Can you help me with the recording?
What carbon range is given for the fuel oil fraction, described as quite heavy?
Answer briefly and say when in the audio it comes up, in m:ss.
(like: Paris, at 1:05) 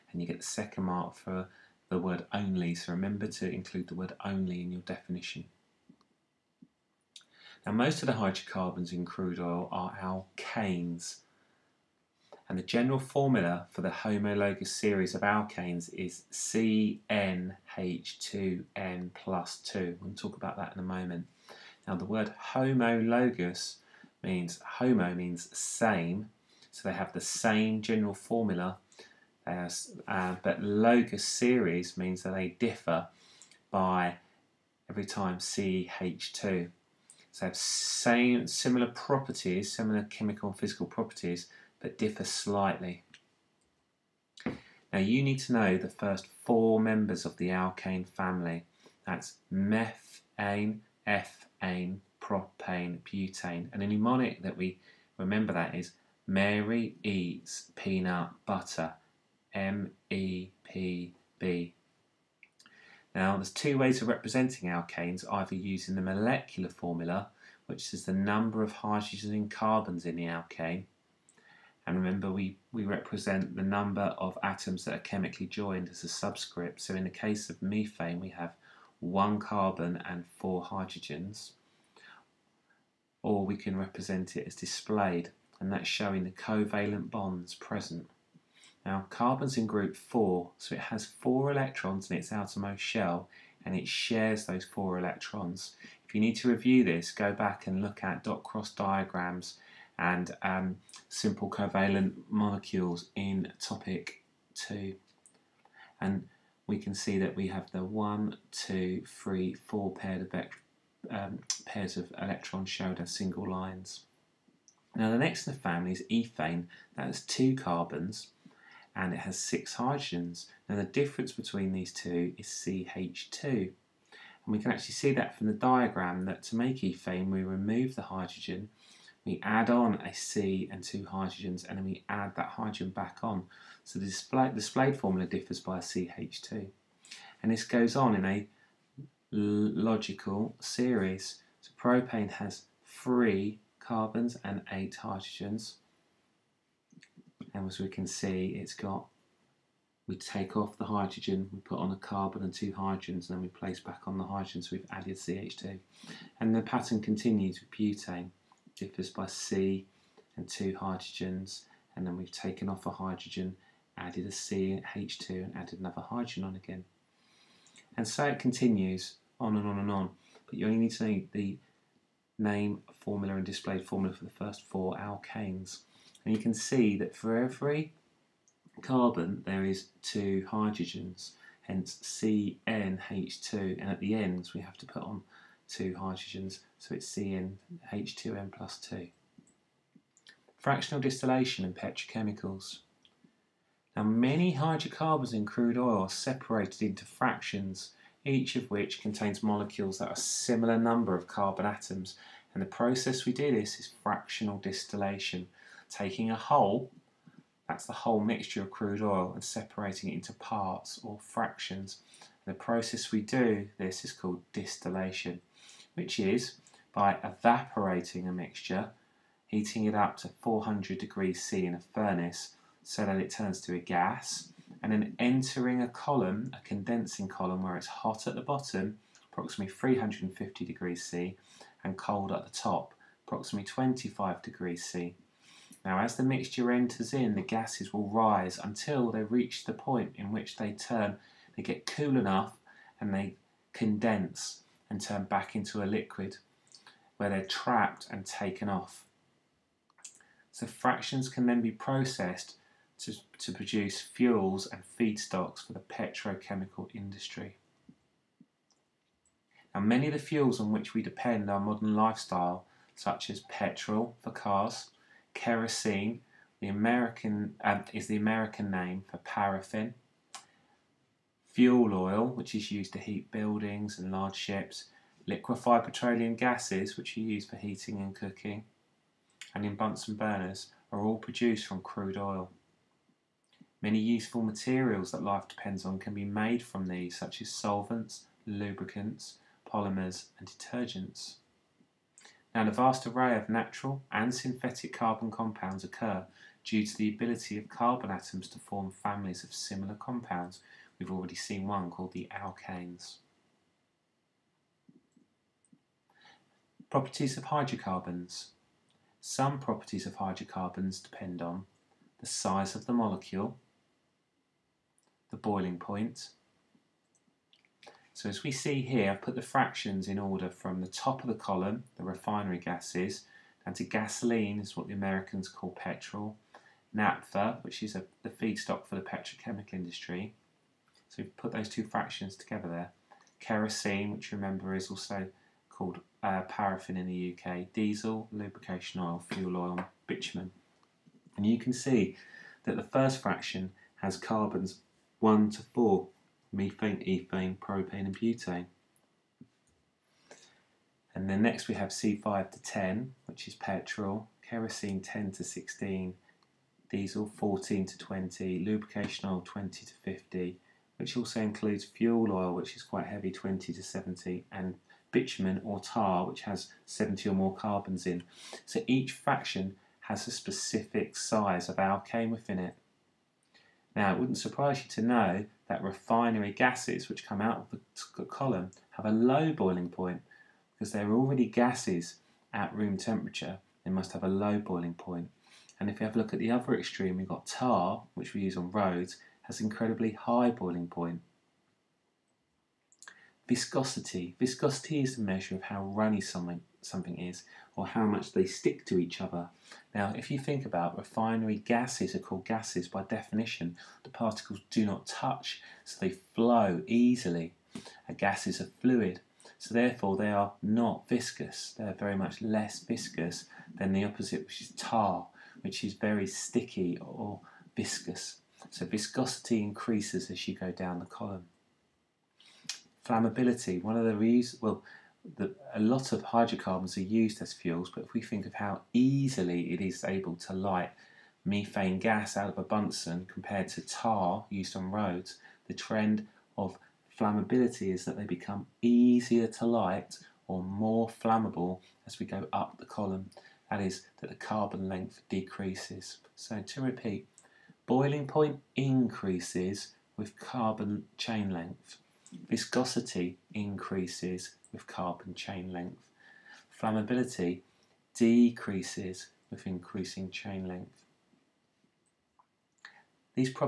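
20 to 70, at 6:03.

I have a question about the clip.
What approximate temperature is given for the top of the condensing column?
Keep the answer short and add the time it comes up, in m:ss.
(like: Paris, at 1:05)
25 degrees C, at 3:53.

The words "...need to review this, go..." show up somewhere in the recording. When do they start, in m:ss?
1:36.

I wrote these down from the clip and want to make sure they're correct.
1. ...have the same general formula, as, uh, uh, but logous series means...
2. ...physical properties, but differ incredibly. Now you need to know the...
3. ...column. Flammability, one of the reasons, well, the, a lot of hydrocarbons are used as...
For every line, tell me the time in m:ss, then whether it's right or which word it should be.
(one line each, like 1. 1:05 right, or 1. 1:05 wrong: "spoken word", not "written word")
1. 0:26 right
2. 0:40 wrong: "slightly", not "incredibly"
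3. 7:01 right.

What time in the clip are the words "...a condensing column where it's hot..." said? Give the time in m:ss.
3:46.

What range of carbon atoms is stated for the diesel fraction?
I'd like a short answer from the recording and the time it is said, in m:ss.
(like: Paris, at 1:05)
14 to 20, at 5:56.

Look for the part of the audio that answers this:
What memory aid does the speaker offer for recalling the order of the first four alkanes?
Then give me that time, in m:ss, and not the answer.
0:56.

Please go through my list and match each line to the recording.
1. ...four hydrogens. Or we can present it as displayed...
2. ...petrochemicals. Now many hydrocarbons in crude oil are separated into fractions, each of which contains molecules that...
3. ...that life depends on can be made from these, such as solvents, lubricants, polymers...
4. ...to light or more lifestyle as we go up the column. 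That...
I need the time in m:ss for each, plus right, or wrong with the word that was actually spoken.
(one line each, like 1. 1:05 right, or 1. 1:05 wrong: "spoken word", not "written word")
1. 1:20 wrong: "represent", not "present"
2. 3:11 right
3. 4:45 right
4. 7:19 wrong: "flammable", not "lifestyle".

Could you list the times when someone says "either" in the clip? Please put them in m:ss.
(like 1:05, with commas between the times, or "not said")
1:05.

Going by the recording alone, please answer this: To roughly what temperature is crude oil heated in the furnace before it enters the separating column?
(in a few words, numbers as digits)
400 degrees C.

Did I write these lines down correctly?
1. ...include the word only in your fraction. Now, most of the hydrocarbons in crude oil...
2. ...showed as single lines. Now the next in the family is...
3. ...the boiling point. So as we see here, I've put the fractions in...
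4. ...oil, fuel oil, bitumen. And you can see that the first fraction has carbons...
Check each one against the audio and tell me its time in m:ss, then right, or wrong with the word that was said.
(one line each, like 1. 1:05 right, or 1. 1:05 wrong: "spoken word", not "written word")
1. 0:03 wrong: "definition", not "fraction"
2. 1:52 right
3. 5:15 right
4. 5:38 right.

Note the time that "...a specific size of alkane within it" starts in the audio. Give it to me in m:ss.
6:10.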